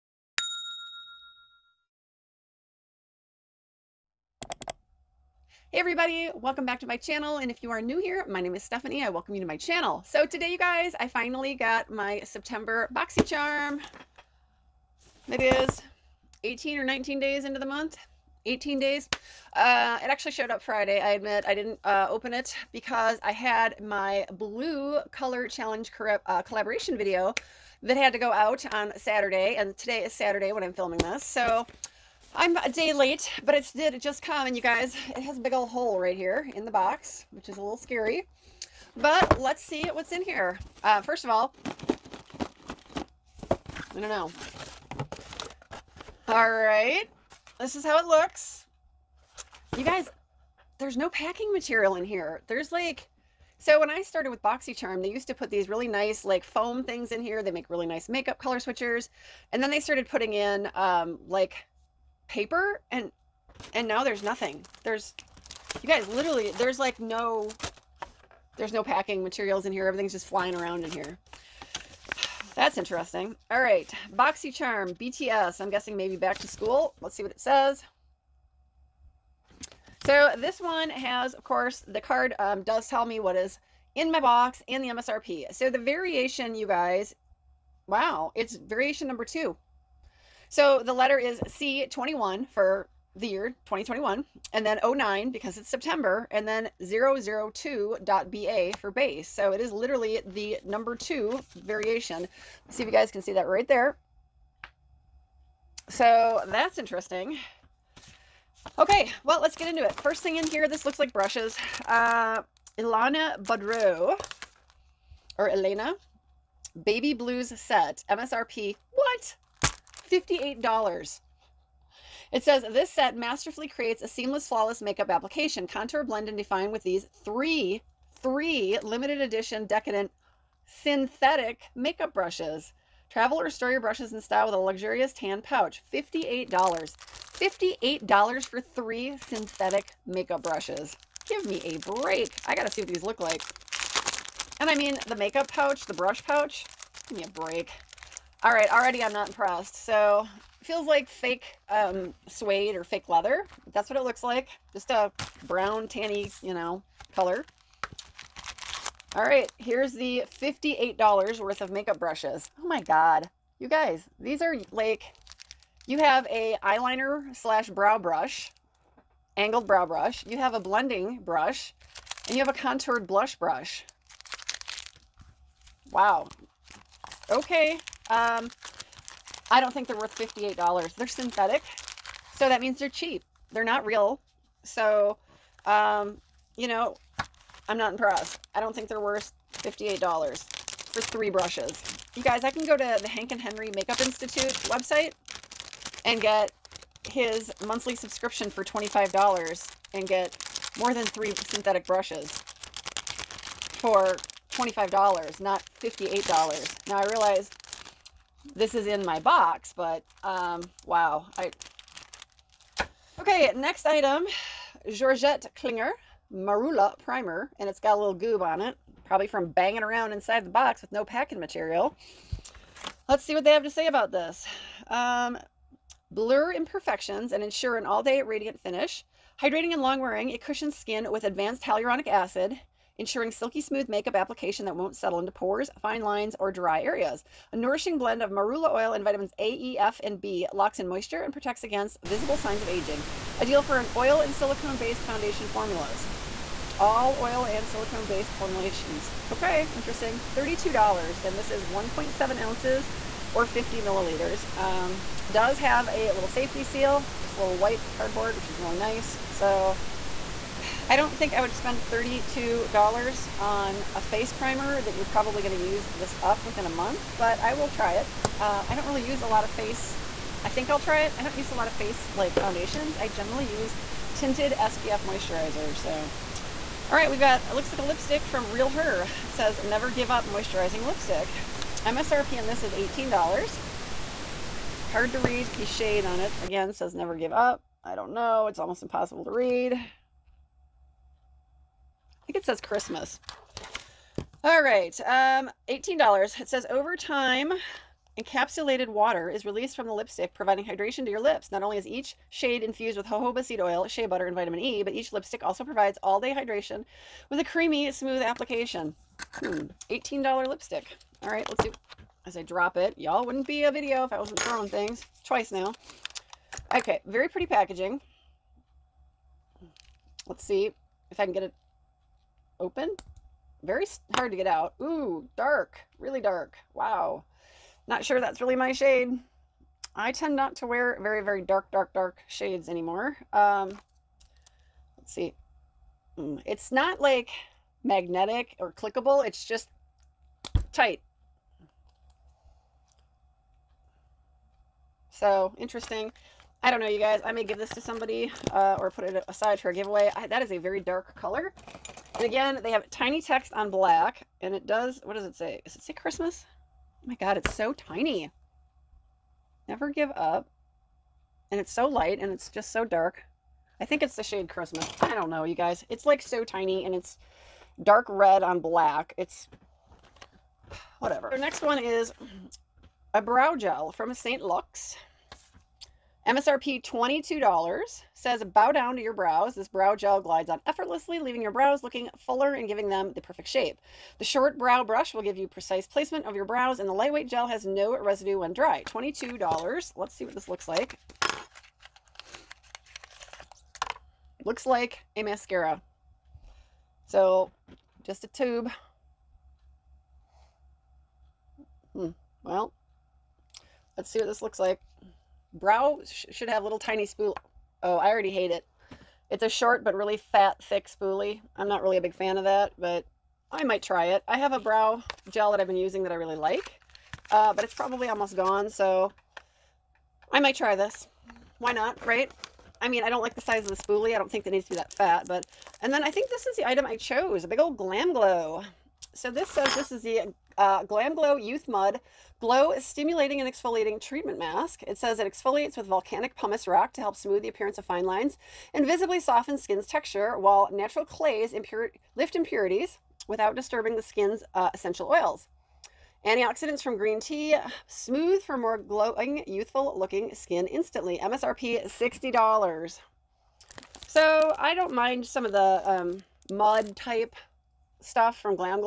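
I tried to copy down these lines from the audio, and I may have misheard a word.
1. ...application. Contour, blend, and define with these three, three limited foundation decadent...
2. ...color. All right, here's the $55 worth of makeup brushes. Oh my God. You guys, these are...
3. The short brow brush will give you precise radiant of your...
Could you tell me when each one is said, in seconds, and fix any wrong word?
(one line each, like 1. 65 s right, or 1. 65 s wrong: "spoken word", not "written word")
1. 125 s wrong: "edition", not "foundation"
2. 157 s wrong: "58", not "55"
3. 384 s wrong: "placement", not "radiant".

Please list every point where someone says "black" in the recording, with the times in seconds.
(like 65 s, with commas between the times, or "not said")
353 s, 368 s.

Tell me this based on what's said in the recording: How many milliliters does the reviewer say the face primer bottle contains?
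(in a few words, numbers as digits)
50.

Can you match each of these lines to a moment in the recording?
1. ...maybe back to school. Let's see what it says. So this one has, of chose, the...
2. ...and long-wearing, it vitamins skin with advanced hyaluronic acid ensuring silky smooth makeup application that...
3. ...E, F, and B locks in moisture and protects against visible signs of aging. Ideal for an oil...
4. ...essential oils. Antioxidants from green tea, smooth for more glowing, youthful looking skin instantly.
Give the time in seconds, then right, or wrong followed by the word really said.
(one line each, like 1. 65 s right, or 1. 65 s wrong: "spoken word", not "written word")
1. 75 s wrong: "course", not "chose"
2. 229 s wrong: "cushions", not "vitamins"
3. 239 s right
4. 444 s right.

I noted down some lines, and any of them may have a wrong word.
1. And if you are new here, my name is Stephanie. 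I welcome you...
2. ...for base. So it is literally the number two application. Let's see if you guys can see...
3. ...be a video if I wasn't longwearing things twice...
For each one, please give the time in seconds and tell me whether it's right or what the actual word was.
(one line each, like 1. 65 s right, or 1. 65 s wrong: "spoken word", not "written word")
1. 7 s right
2. 98 s wrong: "variation", not "application"
3. 313 s wrong: "throwing", not "longwearing".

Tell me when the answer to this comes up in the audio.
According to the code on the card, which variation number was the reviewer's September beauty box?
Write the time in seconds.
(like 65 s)
88 s.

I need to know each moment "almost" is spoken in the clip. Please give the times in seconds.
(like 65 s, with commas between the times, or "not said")
288 s, 418 s.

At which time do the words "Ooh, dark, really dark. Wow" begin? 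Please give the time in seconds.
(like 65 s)
324 s.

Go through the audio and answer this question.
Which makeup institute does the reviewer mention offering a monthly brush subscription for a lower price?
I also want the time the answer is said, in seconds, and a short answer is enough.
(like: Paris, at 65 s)
Hank and Henry, at 193 s.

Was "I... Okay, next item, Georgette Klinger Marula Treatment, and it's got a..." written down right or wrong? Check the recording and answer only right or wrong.
wrong.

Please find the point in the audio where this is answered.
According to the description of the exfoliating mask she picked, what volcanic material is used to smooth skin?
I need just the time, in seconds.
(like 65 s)
436 s.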